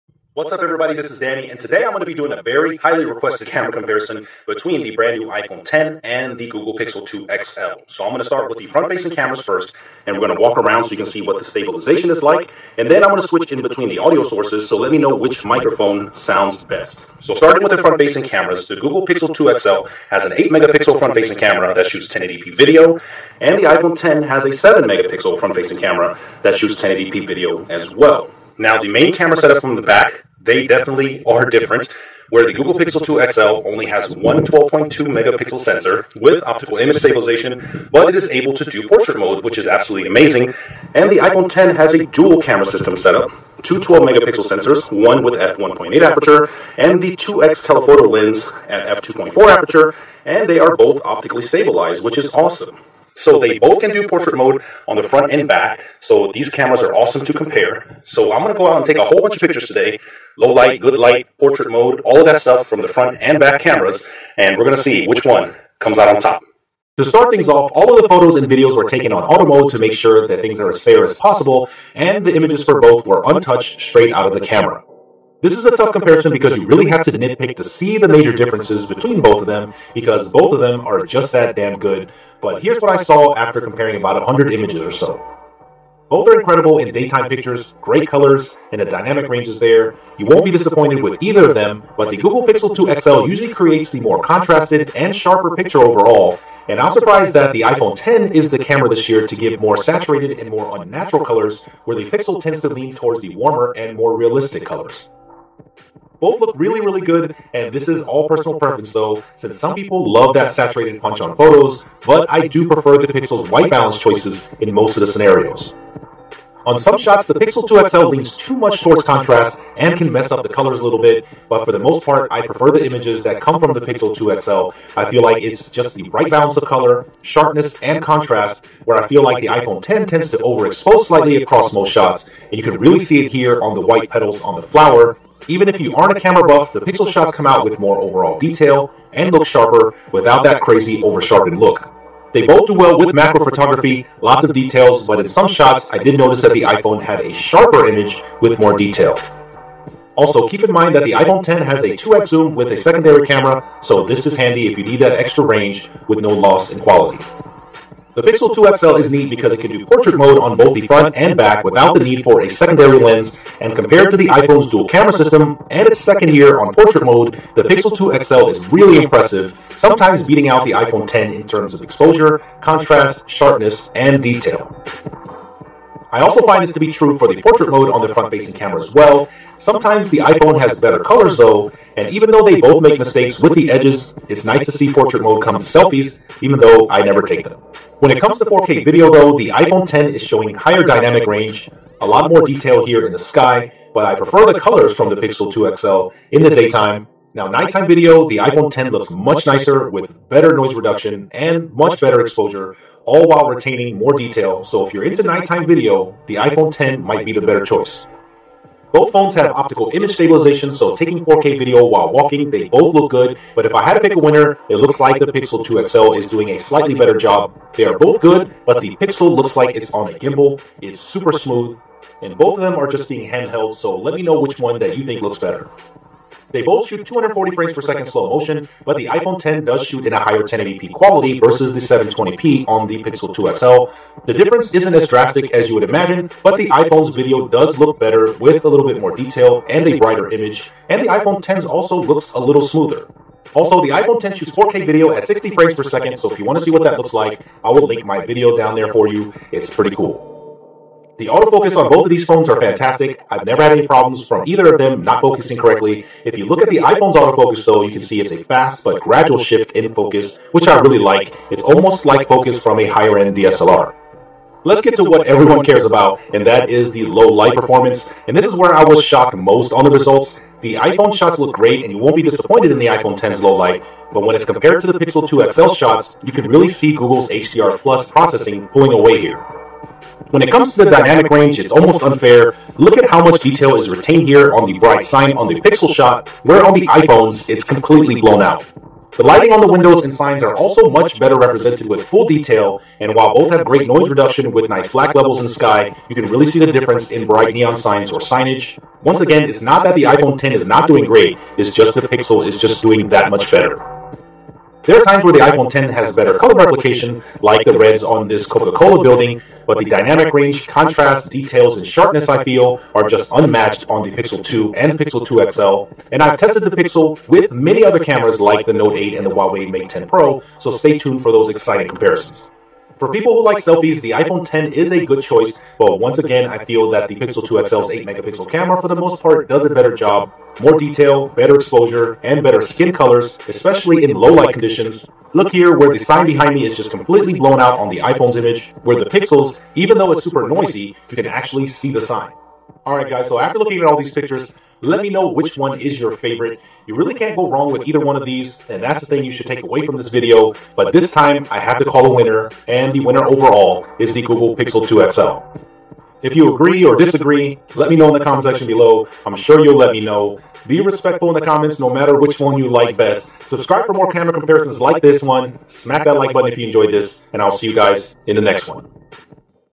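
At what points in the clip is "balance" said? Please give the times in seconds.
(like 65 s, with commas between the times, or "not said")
113 s, 126 s.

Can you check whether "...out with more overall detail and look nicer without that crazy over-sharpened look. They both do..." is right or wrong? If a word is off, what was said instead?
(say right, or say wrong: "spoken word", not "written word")
wrong: "sharper", not "nicer".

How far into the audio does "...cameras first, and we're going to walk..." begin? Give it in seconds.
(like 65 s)
9 s.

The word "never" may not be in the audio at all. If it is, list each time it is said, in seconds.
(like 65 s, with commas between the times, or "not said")
187 s, 253 s.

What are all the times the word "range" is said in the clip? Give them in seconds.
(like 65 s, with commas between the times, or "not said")
89 s, 155 s, 191 s, 281 s, 310 s.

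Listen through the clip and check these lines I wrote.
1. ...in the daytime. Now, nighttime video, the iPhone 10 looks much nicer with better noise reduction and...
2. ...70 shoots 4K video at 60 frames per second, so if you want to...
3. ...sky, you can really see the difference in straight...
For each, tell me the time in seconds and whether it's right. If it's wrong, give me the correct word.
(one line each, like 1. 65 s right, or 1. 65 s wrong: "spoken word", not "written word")
1. 196 s right
2. 244 s wrong: "10", not "70"
3. 295 s wrong: "bright", not "straight".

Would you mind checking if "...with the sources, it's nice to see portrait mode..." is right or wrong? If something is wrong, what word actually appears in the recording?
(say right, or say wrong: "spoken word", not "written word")
wrong: "edges", not "sources".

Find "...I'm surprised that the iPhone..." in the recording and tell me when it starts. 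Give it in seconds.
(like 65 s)
96 s.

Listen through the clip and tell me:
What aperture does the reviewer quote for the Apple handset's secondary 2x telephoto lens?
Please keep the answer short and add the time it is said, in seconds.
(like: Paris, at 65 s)
f2.4, at 49 s.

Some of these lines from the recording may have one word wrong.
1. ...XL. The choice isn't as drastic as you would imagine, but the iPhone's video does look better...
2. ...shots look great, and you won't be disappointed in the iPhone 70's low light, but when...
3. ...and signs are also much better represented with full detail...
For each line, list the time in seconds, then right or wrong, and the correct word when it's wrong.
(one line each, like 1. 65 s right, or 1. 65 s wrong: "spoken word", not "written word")
1. 233 s wrong: "difference", not "choice"
2. 271 s wrong: "10", not "70"
3. 290 s right.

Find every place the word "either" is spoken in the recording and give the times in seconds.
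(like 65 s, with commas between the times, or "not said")
91 s, 254 s, 347 s.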